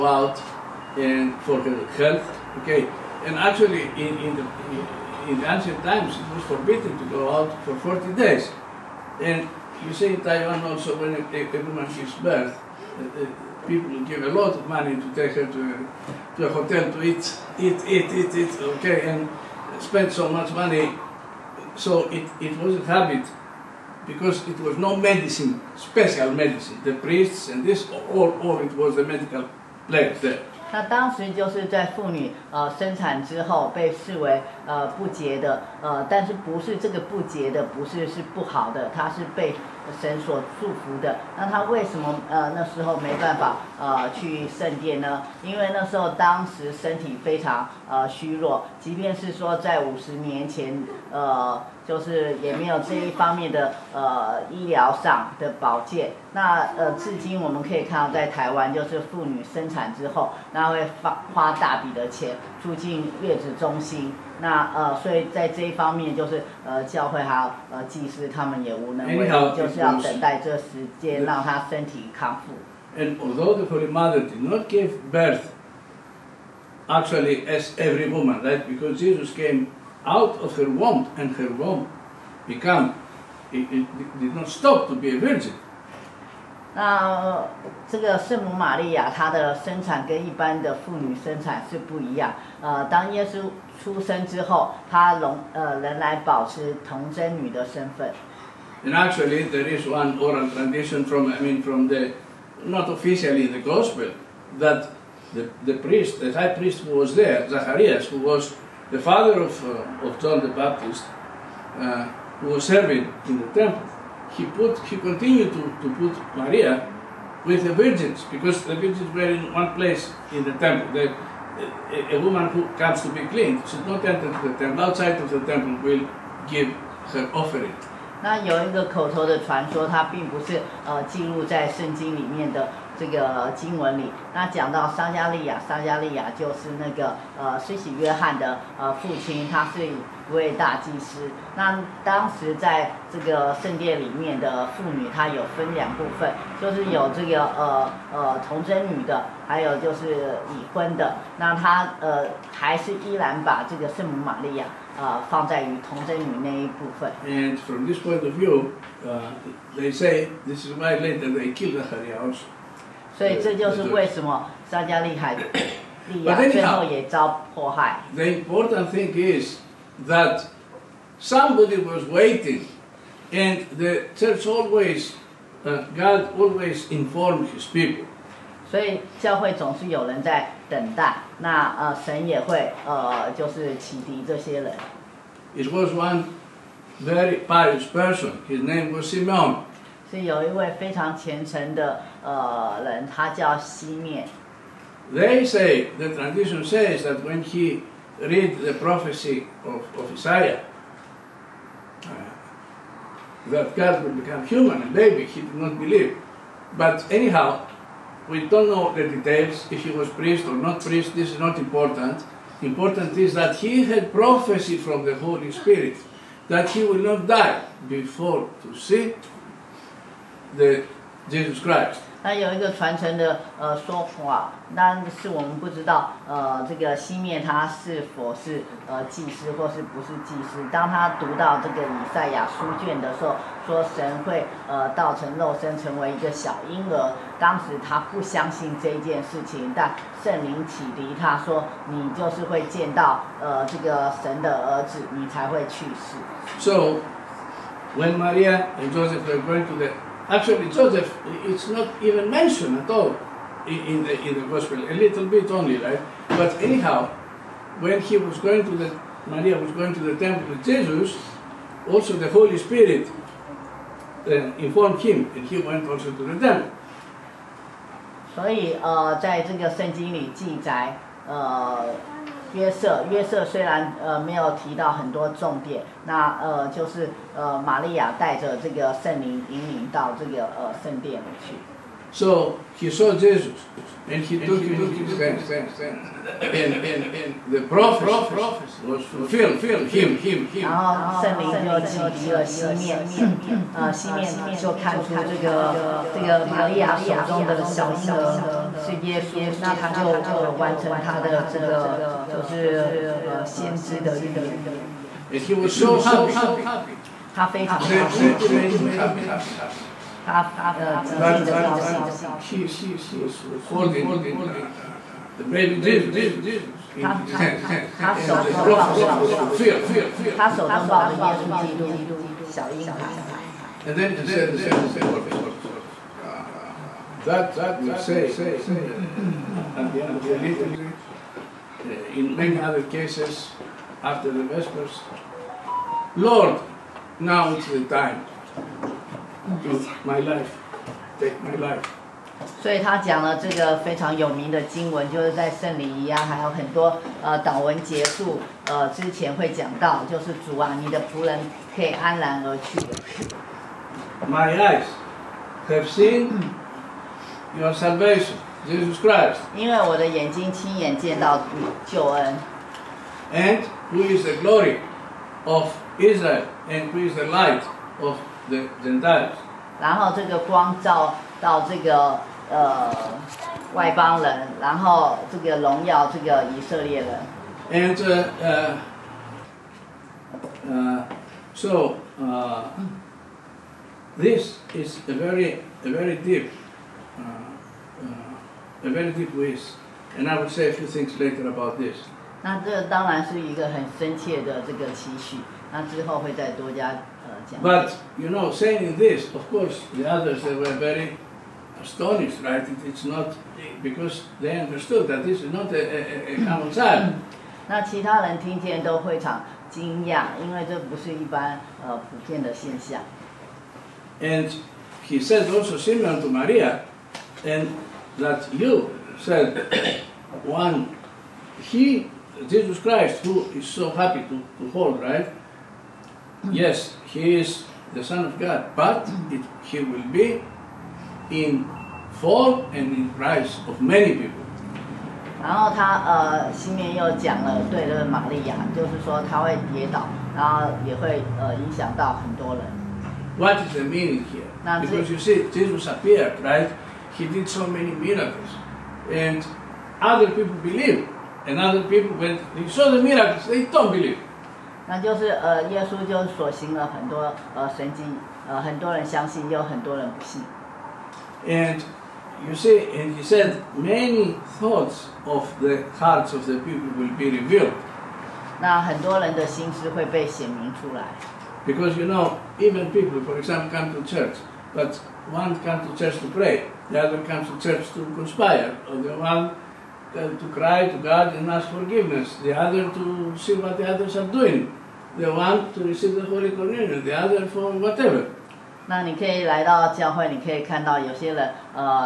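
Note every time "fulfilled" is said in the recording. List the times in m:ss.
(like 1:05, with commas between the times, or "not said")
4:49, 5:19.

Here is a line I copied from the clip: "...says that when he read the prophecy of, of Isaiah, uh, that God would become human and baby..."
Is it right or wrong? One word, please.
right.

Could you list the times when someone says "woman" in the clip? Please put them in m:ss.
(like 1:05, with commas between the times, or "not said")
0:11, 1:18, 2:02.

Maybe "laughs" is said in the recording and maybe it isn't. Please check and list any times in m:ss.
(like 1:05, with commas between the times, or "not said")
not said.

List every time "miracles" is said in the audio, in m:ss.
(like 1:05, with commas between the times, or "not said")
7:27, 7:33.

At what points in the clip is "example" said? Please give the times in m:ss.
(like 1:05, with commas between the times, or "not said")
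7:53.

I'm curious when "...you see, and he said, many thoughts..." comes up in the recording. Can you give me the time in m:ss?
7:42.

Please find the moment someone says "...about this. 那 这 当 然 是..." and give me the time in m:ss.
6:31.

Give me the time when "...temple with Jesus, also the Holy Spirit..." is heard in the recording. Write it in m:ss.
4:20.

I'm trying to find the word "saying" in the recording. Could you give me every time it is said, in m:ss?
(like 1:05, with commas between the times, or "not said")
6:38.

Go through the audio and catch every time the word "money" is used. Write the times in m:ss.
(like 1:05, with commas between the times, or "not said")
0:14, 0:20.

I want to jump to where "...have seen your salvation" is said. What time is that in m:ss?
5:55.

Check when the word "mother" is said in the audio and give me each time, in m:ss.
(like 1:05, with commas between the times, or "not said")
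1:13.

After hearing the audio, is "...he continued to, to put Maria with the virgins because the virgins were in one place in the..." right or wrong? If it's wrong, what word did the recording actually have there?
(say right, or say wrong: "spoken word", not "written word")
right.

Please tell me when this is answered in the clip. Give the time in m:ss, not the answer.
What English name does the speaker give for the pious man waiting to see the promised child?
3:09.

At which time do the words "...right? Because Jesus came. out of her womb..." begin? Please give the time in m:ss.
1:18.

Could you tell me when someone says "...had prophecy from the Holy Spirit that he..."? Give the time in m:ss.
3:33.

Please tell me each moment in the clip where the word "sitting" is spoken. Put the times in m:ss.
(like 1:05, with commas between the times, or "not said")
not said.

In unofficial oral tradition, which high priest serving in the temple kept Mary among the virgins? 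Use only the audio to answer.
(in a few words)
Zacharias.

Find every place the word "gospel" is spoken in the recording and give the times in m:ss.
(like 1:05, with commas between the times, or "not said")
1:43, 4:14.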